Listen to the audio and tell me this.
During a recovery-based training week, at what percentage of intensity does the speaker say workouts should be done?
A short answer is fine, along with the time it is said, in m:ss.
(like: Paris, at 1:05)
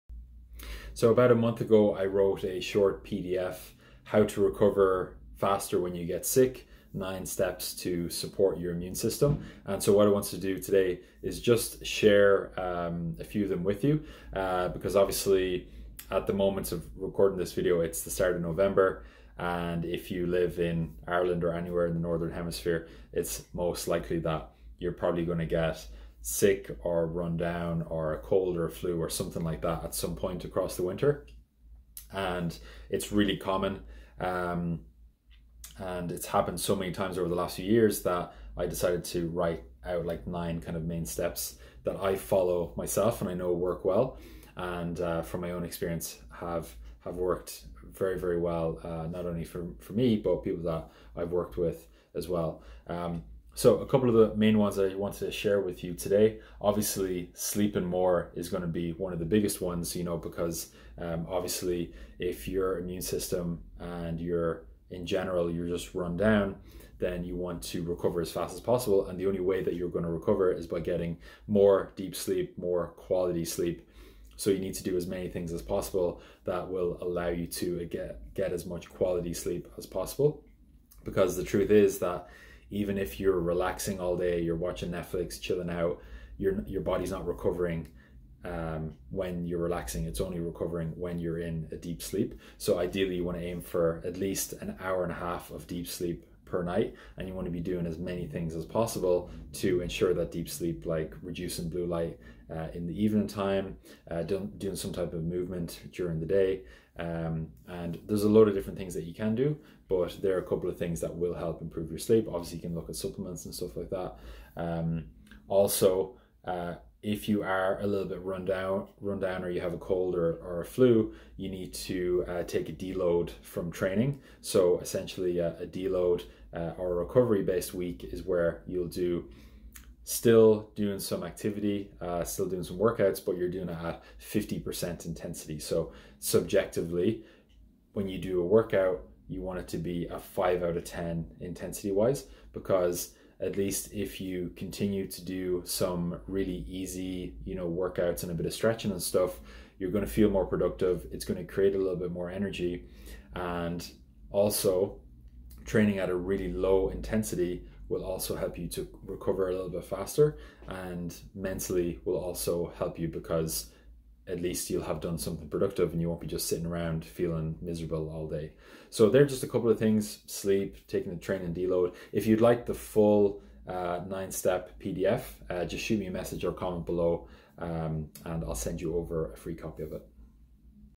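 50%, at 2:14.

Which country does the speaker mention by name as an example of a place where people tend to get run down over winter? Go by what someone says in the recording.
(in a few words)
Ireland.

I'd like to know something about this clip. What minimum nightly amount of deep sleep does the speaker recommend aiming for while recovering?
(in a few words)
an hour and a half.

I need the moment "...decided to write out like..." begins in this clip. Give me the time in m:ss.
0:38.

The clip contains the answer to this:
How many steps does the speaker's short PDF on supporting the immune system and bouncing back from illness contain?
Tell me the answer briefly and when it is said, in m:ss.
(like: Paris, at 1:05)
9, at 0:06.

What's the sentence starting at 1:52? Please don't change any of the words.
Obviously, you can look at supplements and stuff like that.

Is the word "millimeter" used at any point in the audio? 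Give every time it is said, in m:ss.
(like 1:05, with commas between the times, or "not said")
not said.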